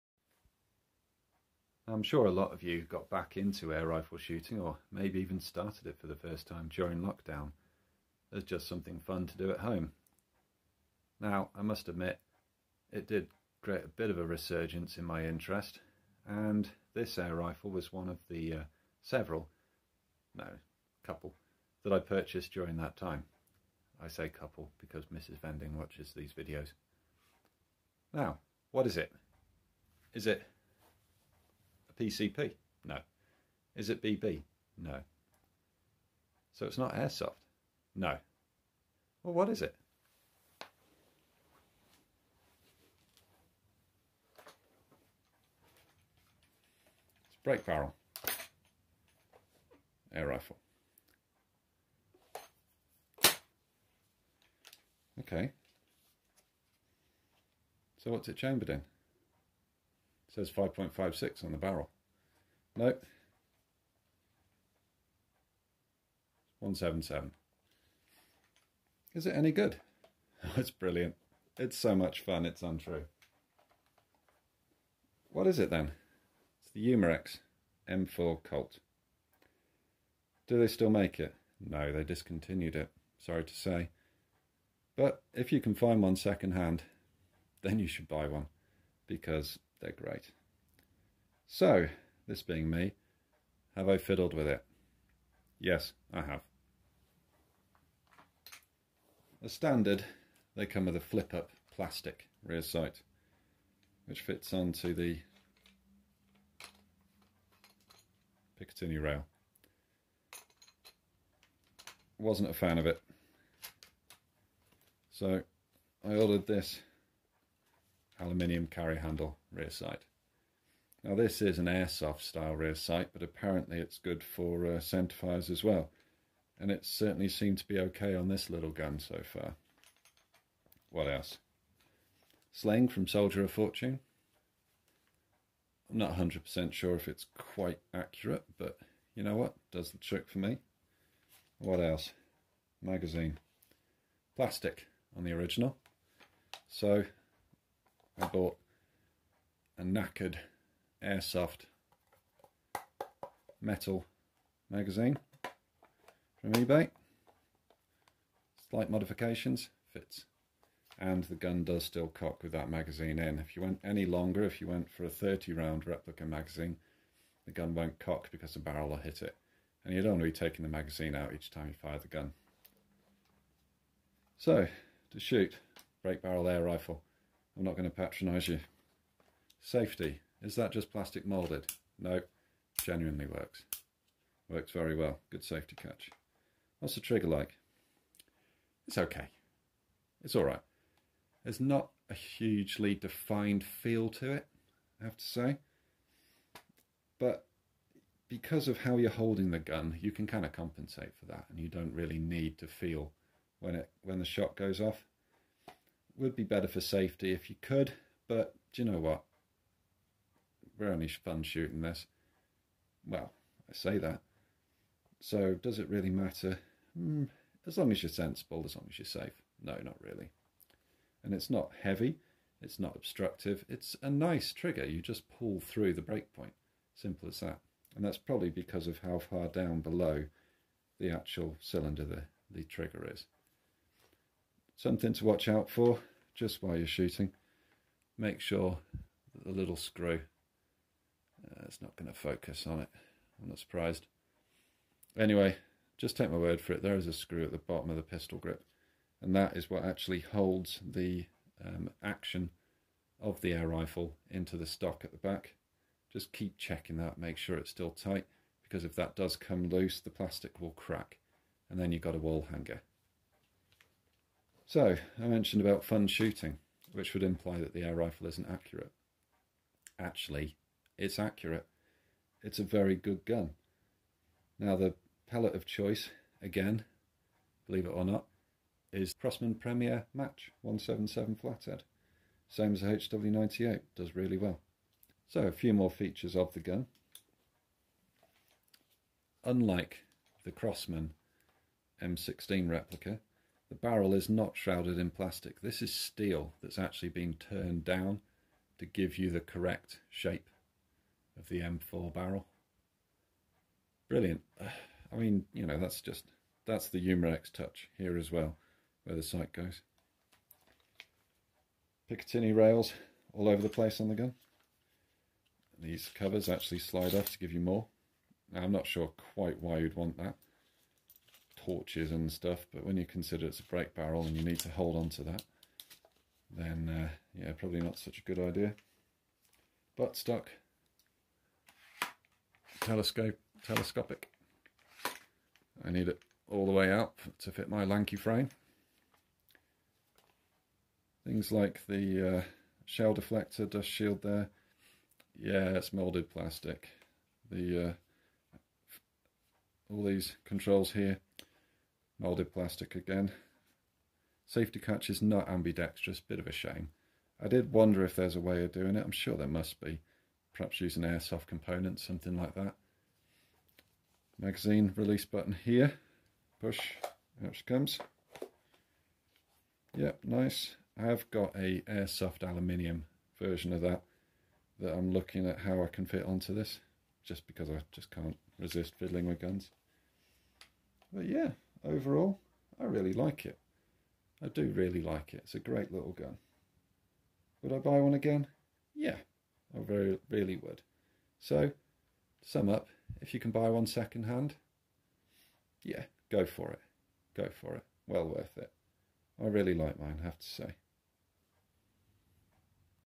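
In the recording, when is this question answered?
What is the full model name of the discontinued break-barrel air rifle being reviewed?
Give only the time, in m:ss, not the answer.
1:16.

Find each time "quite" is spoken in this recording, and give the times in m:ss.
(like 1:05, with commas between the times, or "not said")
2:17, 5:19.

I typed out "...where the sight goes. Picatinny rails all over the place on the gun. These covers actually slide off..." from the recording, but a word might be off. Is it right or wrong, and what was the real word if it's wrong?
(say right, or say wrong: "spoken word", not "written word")
right.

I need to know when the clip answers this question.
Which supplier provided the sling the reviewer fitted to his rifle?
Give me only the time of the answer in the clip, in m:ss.
2:13.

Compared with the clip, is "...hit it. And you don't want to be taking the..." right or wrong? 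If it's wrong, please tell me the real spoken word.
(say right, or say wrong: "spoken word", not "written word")
right.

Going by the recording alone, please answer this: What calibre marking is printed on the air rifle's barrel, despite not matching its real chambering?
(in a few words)
5.56.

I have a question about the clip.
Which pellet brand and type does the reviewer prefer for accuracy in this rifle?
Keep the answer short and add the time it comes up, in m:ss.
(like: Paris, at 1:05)
Crosman Premier Match, at 4:39.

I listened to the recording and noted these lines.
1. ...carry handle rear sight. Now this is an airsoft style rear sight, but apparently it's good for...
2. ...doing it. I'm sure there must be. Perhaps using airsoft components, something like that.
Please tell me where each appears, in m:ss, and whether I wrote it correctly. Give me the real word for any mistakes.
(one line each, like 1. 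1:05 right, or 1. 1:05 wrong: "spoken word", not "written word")
1. 1:58 right
2. 5:58 right.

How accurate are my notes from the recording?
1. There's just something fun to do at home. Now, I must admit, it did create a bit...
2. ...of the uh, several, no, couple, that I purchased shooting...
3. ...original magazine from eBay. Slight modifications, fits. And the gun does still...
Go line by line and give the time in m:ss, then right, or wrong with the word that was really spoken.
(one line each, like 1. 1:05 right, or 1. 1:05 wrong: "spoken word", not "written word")
1. 0:08 right
2. 0:18 wrong: "during", not "shooting"
3. 2:33 wrong: "metal", not "original".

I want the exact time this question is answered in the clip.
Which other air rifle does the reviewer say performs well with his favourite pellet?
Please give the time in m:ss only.
4:42.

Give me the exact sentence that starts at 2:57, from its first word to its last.
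I'm not going to patronise you.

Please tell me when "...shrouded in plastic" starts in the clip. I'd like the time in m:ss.
4:54.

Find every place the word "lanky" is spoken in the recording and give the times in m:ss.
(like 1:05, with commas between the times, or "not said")
5:37.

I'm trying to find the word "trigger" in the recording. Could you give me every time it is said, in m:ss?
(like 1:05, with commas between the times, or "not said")
3:07, 3:44, 3:52.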